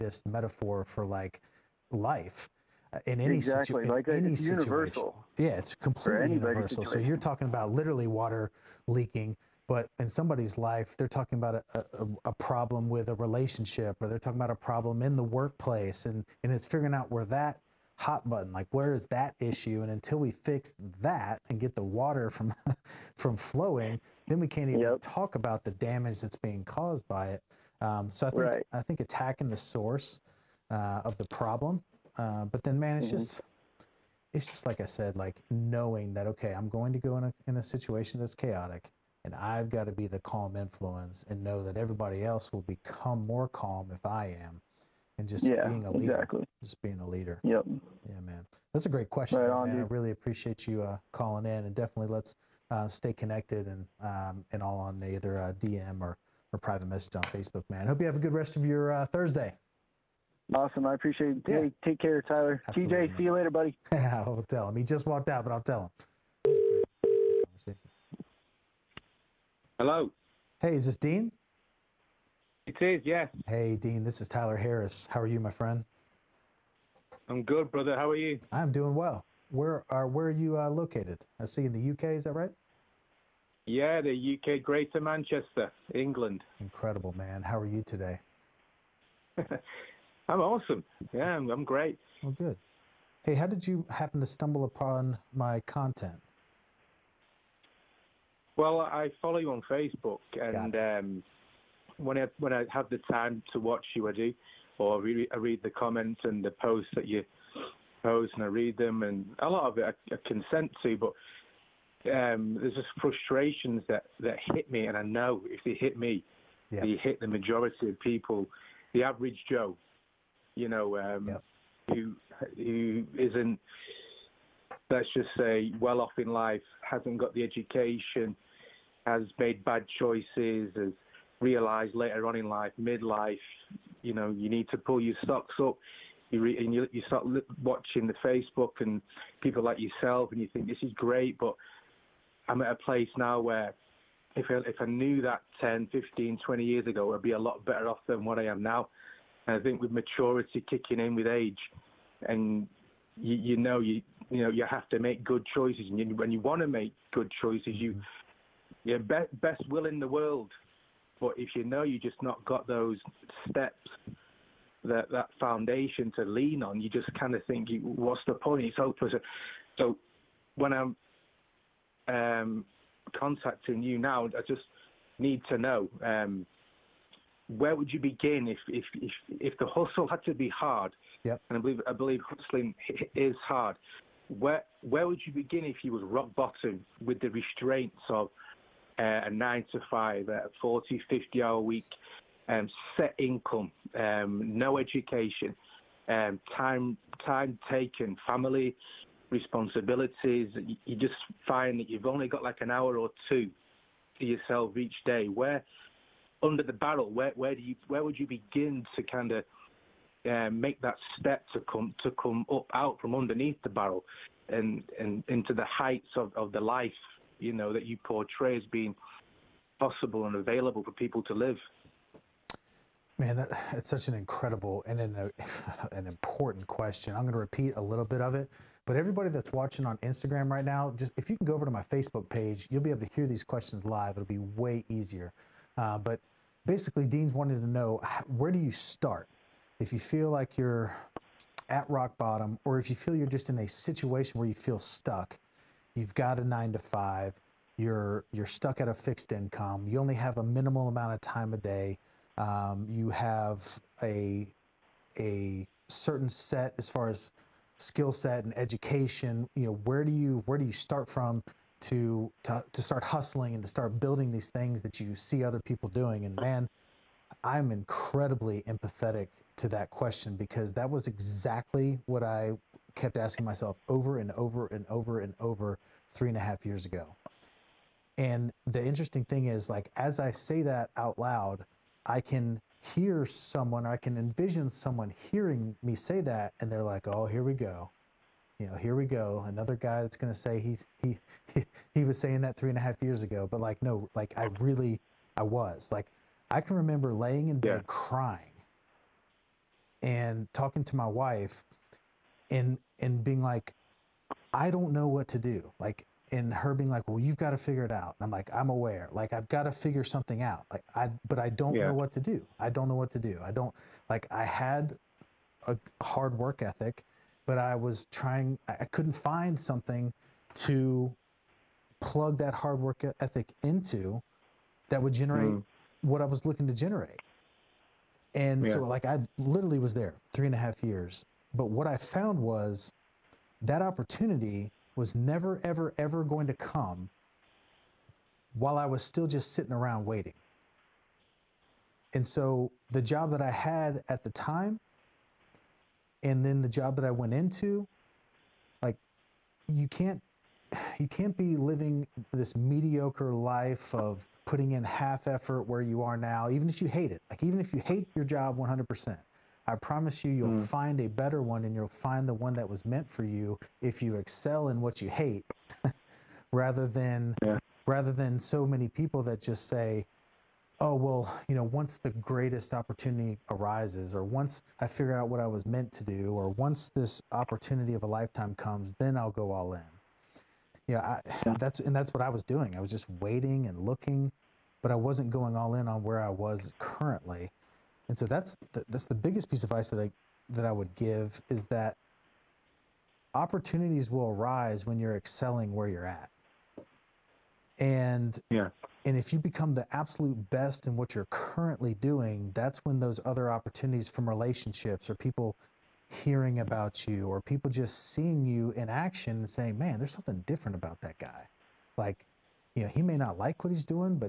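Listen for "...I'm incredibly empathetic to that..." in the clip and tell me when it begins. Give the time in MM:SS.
04:27.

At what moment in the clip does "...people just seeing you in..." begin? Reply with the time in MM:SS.
06:47.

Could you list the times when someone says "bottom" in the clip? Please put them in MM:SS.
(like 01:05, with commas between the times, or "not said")
03:06, 04:02.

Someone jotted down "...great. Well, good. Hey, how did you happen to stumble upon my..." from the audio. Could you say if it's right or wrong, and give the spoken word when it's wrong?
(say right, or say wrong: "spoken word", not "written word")
right.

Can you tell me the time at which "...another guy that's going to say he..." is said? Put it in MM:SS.
04:49.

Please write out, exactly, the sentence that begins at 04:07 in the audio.
You're you're stuck at a fixed income.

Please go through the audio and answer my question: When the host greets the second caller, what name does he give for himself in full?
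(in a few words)
Tyler Harris.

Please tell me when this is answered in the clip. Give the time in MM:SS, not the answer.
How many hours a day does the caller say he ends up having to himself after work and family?
03:22.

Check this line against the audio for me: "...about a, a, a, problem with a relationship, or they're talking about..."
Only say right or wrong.
right.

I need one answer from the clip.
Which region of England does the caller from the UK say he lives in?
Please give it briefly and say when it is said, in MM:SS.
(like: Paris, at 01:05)
Greater Manchester, at 01:24.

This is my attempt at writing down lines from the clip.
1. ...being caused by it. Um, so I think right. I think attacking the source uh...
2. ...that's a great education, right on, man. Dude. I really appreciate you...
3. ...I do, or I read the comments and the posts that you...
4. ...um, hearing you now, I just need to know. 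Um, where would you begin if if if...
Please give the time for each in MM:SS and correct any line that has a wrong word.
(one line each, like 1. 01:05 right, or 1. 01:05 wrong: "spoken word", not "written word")
1. 00:26 right
2. 00:48 wrong: "question", not "education"
3. 01:44 right
4. 02:52 wrong: "contacting", not "hearing".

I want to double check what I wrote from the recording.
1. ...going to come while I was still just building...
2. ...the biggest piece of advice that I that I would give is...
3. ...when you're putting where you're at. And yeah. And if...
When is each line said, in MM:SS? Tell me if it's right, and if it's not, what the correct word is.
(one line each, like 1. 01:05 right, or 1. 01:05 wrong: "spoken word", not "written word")
1. 05:36 wrong: "sitting", not "building"
2. 06:29 right
3. 06:34 wrong: "excelling", not "putting".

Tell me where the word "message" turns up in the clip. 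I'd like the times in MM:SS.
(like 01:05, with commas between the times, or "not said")
00:56.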